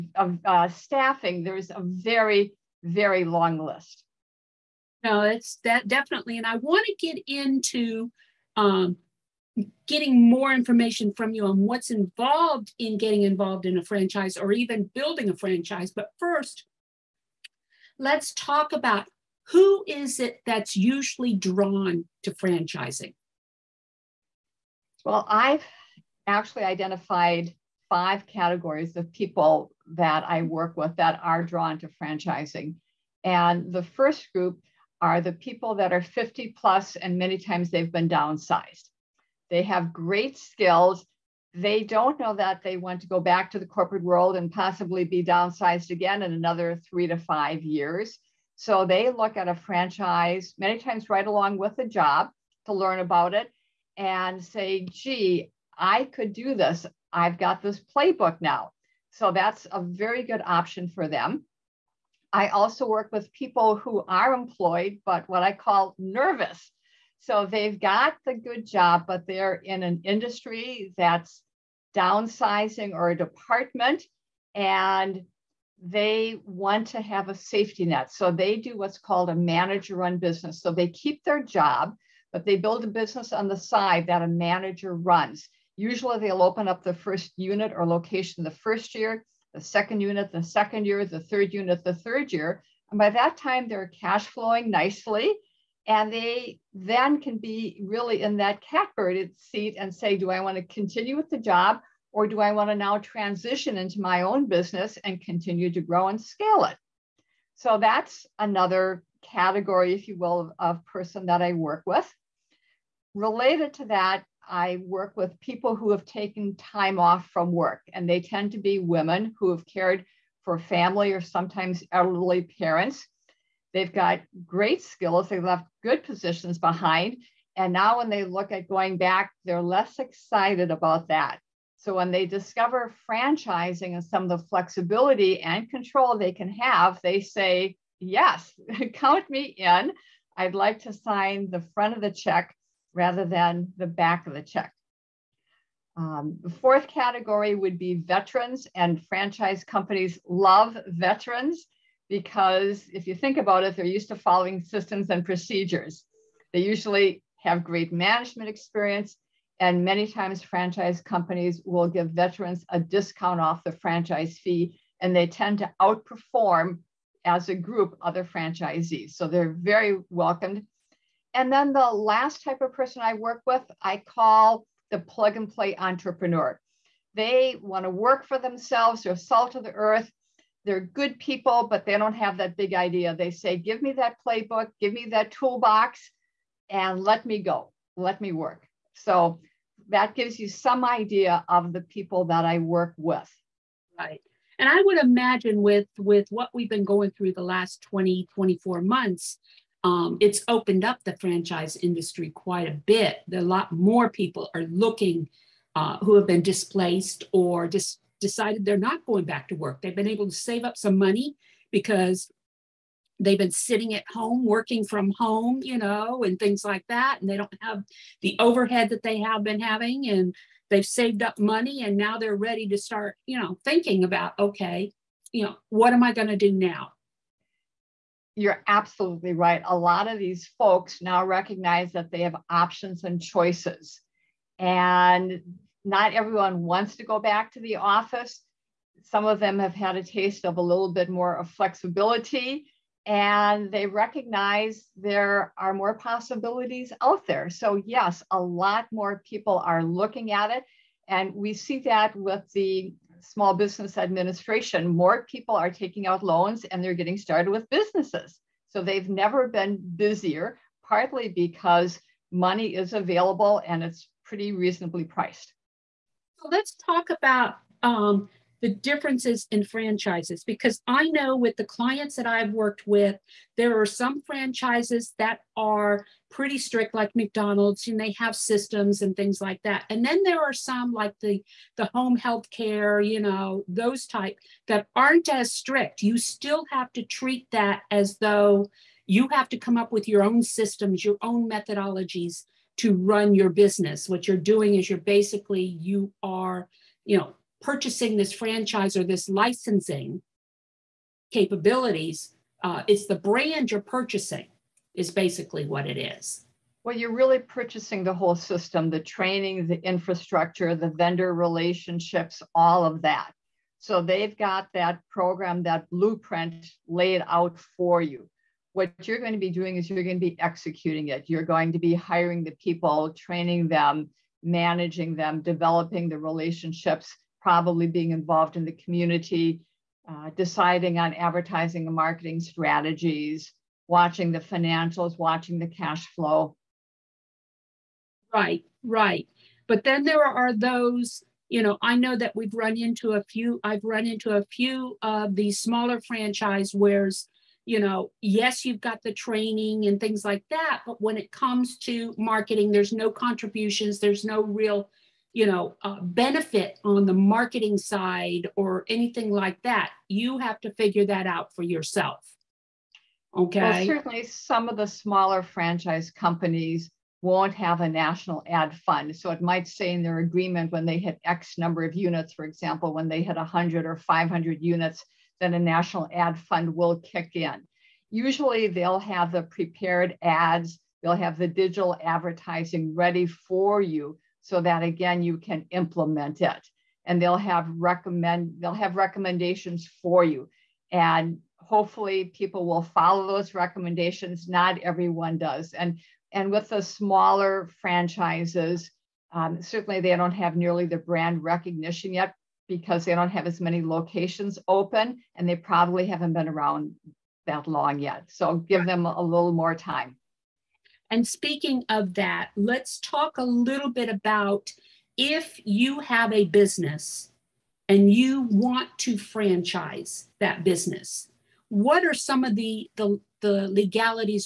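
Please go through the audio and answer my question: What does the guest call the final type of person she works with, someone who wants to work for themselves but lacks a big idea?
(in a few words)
plug and play entrepreneur.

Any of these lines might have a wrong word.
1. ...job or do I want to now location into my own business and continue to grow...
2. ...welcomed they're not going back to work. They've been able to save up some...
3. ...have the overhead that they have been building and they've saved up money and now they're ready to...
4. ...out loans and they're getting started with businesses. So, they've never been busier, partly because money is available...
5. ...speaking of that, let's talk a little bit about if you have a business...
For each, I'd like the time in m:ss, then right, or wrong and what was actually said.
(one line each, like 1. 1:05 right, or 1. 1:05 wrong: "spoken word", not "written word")
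1. 1:41 wrong: "transition", not "location"
2. 3:28 wrong: "decided", not "welcomed"
3. 3:37 wrong: "having", not "building"
4. 4:16 right
5. 6:51 right.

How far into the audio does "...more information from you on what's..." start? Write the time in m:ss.
0:10.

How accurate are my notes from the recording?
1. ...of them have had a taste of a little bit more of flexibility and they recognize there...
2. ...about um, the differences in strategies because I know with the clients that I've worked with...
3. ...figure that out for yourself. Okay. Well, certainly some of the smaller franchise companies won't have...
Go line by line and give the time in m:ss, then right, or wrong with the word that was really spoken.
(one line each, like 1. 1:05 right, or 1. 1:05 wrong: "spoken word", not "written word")
1. 3:59 right
2. 4:27 wrong: "franchises", not "strategies"
3. 6:00 right.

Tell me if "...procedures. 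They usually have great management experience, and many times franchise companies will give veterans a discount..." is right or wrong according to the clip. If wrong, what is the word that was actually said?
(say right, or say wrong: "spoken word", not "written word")
right.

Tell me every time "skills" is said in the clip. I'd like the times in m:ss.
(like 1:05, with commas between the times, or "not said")
0:40, 2:04.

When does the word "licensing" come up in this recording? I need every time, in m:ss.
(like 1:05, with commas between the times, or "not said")
4:59.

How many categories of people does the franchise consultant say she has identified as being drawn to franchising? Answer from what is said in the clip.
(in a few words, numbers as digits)
5.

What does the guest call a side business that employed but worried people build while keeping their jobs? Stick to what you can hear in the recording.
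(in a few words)
manager run business.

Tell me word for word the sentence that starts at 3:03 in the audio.
They say, give me that playbook, give me that toolbox, and let me go, let me work.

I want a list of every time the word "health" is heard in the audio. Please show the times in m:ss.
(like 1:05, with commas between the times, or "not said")
4:42.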